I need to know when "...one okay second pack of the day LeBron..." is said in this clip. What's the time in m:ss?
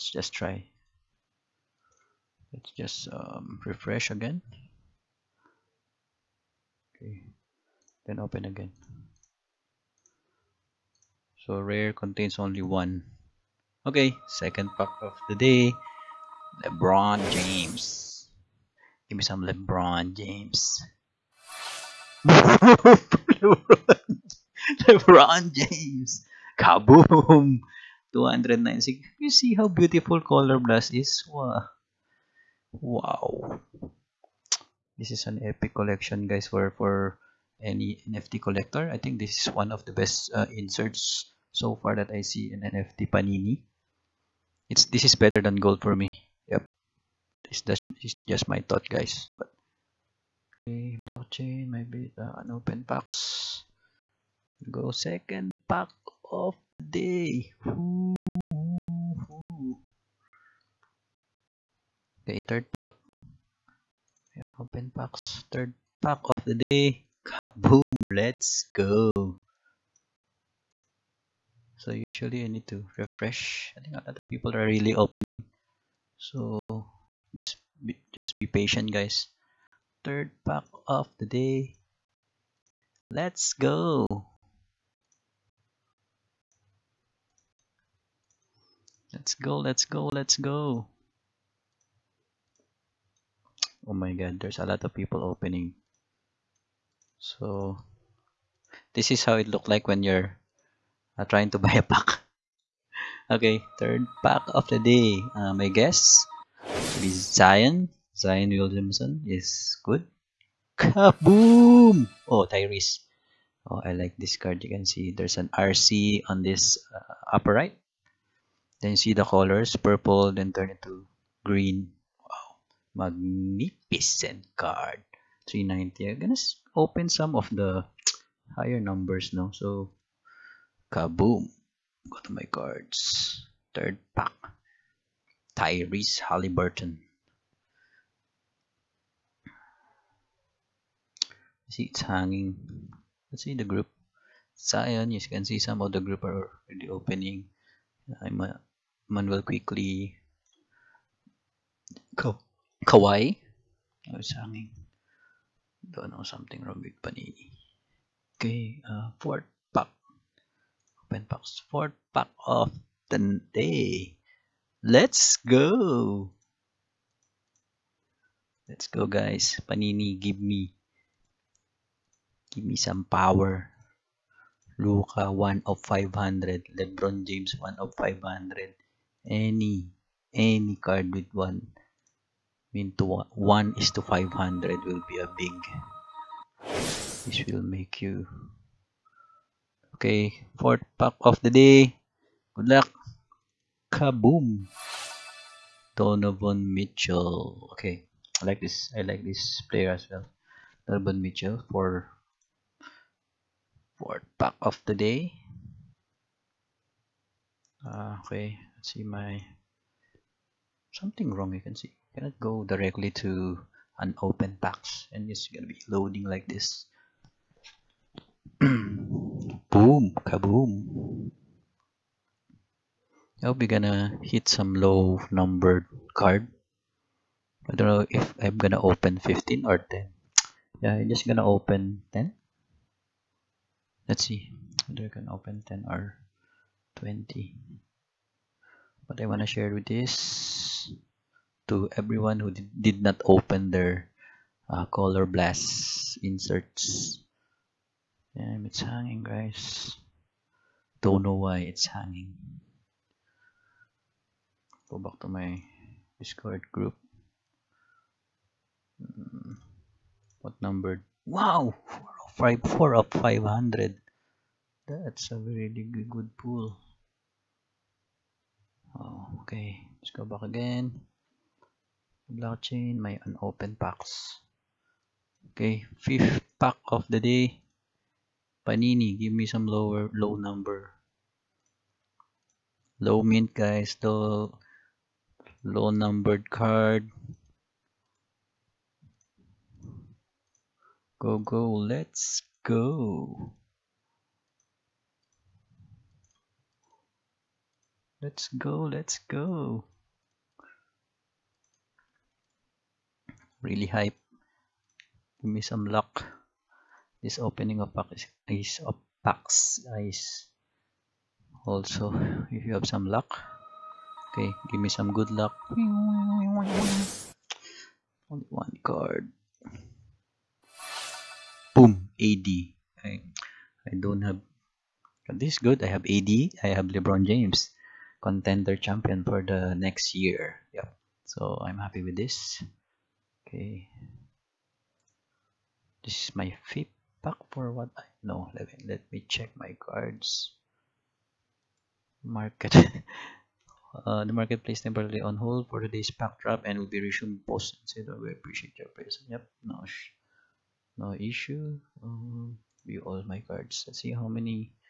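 0:12.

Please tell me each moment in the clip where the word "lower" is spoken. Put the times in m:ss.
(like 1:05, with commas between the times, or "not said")
4:39.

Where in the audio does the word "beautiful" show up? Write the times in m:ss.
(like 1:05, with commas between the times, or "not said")
0:29.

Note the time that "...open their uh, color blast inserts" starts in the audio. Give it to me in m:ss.
4:03.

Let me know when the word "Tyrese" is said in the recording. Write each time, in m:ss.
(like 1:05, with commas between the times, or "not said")
1:52, 2:15.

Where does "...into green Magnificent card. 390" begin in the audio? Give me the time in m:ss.
2:00.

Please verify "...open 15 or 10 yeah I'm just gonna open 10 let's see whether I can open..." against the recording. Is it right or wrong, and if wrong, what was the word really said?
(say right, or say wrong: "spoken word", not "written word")
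right.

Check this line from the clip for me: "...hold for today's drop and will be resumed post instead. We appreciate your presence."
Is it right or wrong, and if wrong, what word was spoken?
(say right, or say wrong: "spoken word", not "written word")
right.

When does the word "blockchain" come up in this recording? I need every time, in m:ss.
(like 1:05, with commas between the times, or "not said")
0:51, 4:32.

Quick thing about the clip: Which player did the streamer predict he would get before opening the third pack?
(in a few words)
Zion Williamson.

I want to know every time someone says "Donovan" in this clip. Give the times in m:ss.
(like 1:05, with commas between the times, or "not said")
3:15, 3:20.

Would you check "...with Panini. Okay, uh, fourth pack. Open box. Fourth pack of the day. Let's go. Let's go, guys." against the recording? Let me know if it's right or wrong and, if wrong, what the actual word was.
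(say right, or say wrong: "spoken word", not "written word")
right.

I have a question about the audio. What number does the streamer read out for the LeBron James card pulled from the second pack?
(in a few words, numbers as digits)
296.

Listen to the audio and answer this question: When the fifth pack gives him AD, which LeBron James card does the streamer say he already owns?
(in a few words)
Contender Champion.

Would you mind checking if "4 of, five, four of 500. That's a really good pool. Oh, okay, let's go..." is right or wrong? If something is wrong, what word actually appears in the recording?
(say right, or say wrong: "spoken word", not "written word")
right.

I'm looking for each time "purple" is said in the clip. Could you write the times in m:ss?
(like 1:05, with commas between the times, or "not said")
1:59.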